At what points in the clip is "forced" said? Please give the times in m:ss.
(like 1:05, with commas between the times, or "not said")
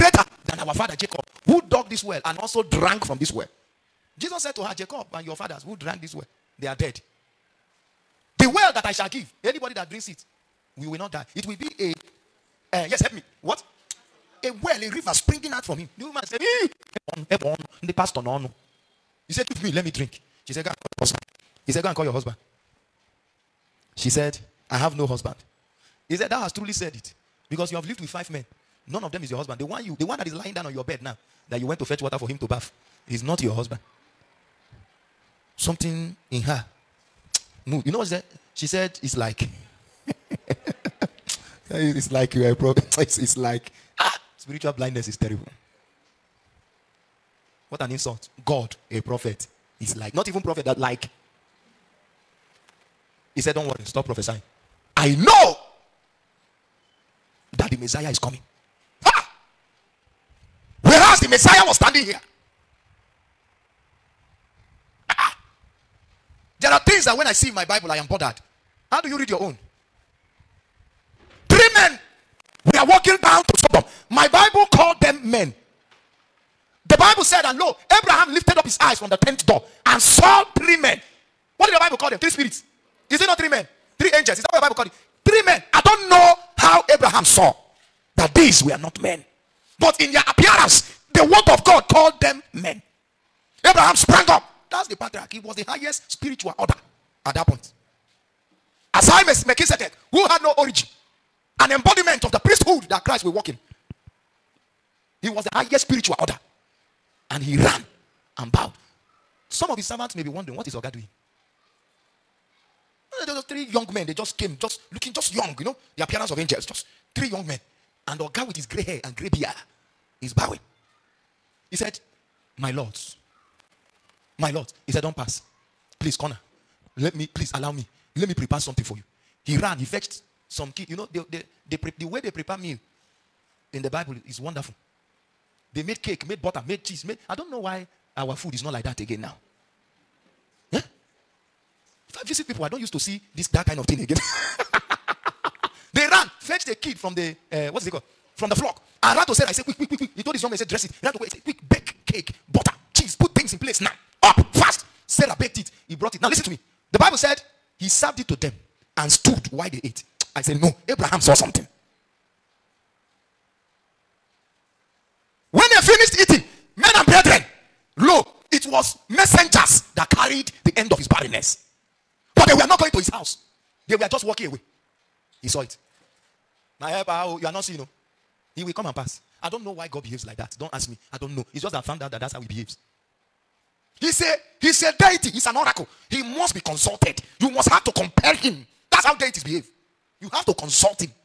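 not said.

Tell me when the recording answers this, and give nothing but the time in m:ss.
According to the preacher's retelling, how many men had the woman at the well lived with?
0:28.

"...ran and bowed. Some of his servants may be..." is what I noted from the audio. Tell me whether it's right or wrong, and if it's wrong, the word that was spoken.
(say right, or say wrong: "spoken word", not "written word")
right.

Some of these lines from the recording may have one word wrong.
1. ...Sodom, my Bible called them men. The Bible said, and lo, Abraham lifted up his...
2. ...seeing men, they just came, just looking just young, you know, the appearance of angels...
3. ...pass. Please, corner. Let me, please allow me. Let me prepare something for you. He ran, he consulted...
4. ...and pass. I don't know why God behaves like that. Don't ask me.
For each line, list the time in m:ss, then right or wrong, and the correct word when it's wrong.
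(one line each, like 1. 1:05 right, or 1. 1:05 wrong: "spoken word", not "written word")
1. 1:13 right
2. 1:53 wrong: "young", not "seeing"
3. 2:05 wrong: "fetched", not "consulted"
4. 2:58 right.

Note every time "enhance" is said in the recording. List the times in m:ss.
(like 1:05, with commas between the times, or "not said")
not said.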